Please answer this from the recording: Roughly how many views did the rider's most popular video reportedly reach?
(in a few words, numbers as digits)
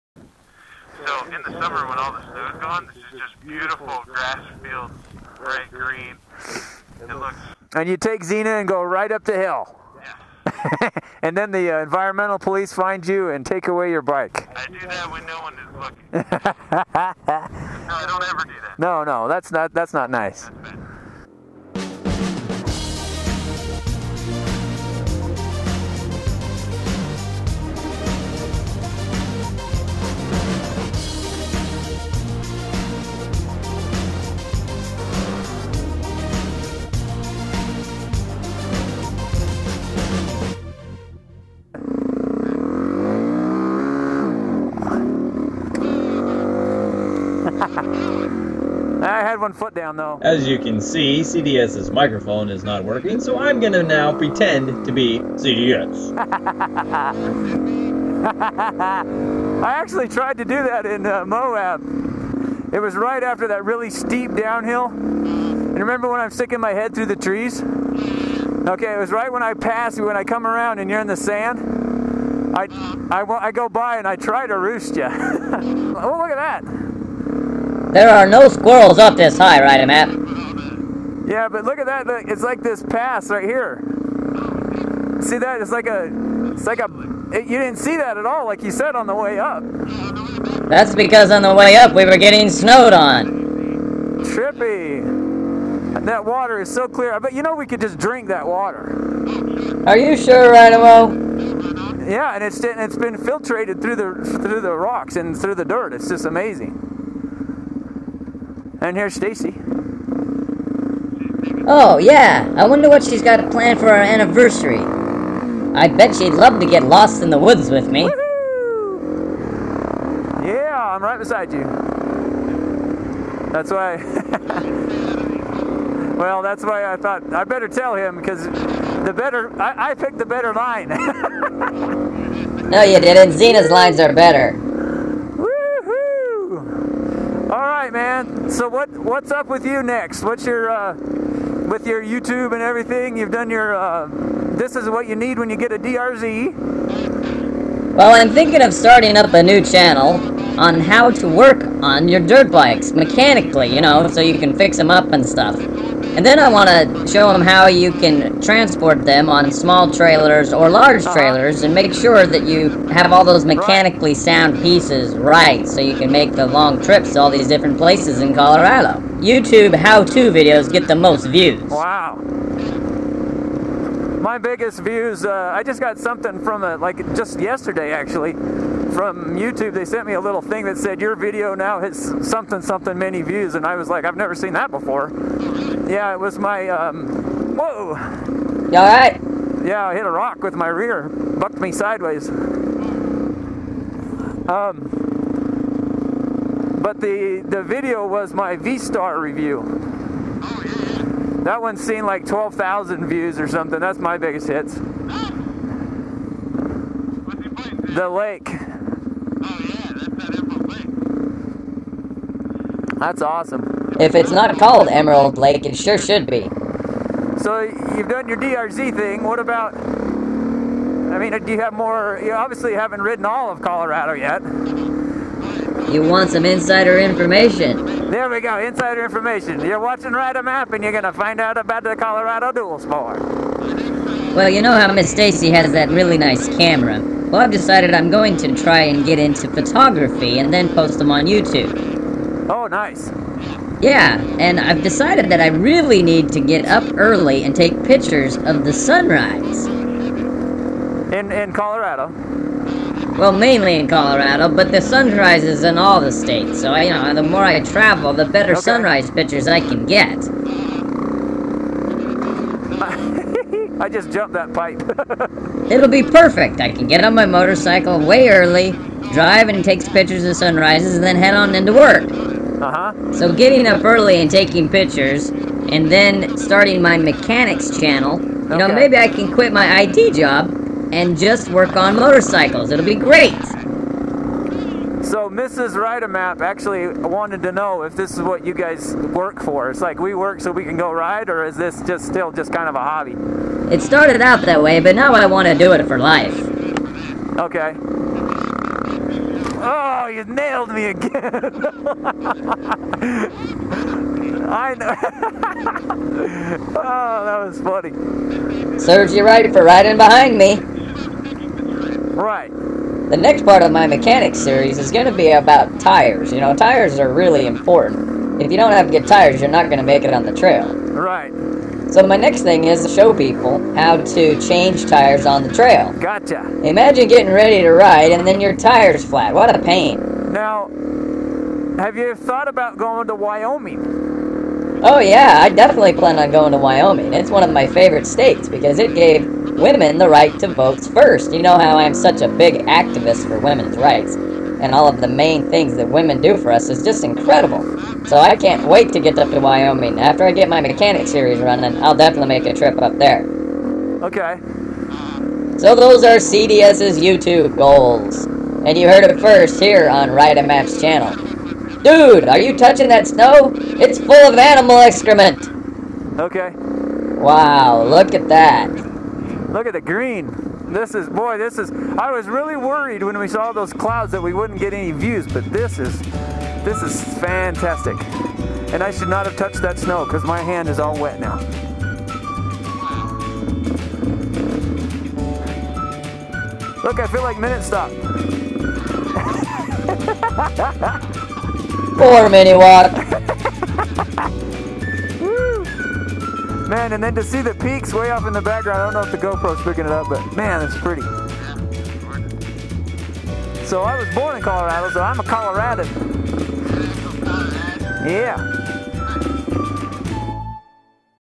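12,000.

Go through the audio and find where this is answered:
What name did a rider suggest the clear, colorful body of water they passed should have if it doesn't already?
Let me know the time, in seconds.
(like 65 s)
214 s.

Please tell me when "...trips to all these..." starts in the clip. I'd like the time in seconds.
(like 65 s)
166 s.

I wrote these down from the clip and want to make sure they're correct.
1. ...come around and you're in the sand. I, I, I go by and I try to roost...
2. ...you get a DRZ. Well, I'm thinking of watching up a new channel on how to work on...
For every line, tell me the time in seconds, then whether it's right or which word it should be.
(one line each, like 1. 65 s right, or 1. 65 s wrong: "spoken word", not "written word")
1. 70 s right
2. 145 s wrong: "starting", not "watching".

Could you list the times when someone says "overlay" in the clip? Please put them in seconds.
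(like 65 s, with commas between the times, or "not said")
not said.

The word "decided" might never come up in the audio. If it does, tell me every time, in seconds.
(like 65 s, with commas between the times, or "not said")
237 s, 244 s.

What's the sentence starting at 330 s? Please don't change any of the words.
Now, have you thought about going to Wyoming?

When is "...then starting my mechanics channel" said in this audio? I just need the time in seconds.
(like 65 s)
275 s.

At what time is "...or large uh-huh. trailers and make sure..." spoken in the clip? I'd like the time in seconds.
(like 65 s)
160 s.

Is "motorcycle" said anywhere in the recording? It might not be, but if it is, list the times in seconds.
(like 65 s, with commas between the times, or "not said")
267 s, 281 s.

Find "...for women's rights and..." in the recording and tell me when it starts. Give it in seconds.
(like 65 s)
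343 s.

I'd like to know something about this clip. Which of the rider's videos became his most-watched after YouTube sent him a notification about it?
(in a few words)
V-Star review.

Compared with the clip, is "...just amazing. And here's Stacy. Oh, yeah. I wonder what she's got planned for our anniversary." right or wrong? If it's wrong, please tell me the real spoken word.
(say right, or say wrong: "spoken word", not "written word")
right.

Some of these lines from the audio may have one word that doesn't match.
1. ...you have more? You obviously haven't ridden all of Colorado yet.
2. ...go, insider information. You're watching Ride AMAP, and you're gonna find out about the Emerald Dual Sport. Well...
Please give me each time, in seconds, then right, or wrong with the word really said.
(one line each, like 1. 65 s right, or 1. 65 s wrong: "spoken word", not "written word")
1. 221 s right
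2. 228 s wrong: "Colorado", not "Emerald".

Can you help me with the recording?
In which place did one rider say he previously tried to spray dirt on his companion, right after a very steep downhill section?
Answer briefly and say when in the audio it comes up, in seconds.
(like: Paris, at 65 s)
Moab, at 61 s.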